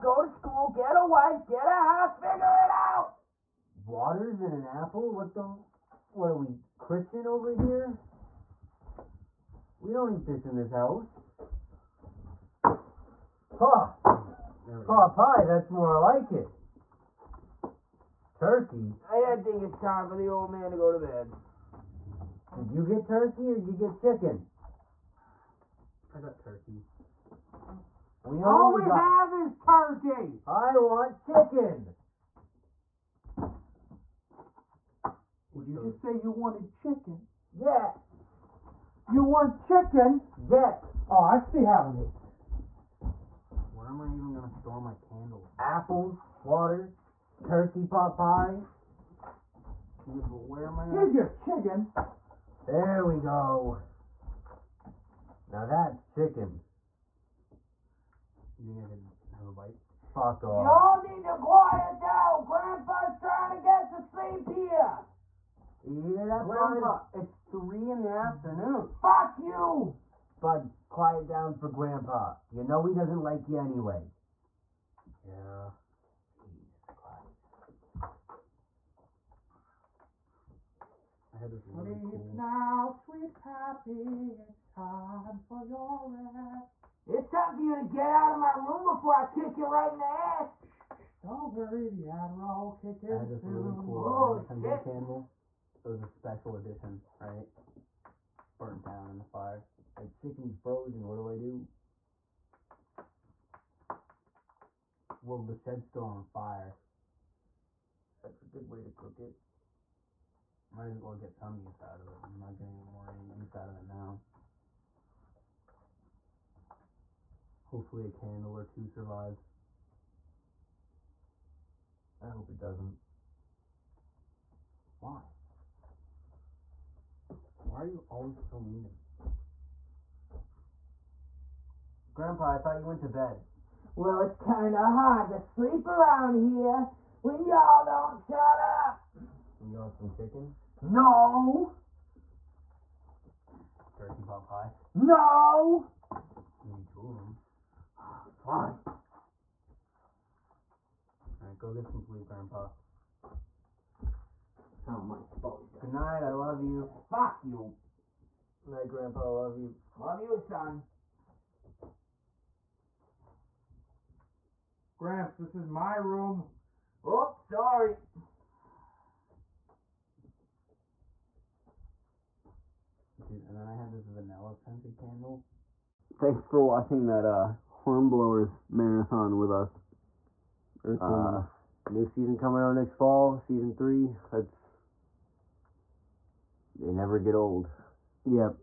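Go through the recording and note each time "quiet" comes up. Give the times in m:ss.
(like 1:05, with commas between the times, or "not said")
1:01, 1:10.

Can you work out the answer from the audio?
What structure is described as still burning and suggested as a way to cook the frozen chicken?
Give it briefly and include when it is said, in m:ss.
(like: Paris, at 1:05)
the shed, at 1:45.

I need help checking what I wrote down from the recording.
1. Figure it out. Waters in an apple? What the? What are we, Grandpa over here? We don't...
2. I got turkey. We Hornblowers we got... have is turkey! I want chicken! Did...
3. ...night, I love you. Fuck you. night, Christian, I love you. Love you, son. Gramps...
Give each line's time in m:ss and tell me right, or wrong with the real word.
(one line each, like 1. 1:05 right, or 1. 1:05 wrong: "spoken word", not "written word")
1. 0:02 wrong: "Christian", not "Grandpa"
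2. 0:26 wrong: "All", not "Hornblowers"
3. 2:35 wrong: "Grandpa", not "Christian".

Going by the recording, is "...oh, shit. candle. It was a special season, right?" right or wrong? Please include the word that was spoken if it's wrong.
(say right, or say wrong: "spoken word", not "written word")
wrong: "edition", not "season".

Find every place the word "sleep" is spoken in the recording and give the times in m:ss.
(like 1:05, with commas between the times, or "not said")
1:04, 1:21, 2:15, 2:32.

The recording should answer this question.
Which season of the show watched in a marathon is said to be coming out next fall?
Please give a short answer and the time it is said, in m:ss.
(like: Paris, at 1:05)
season 3, at 3:03.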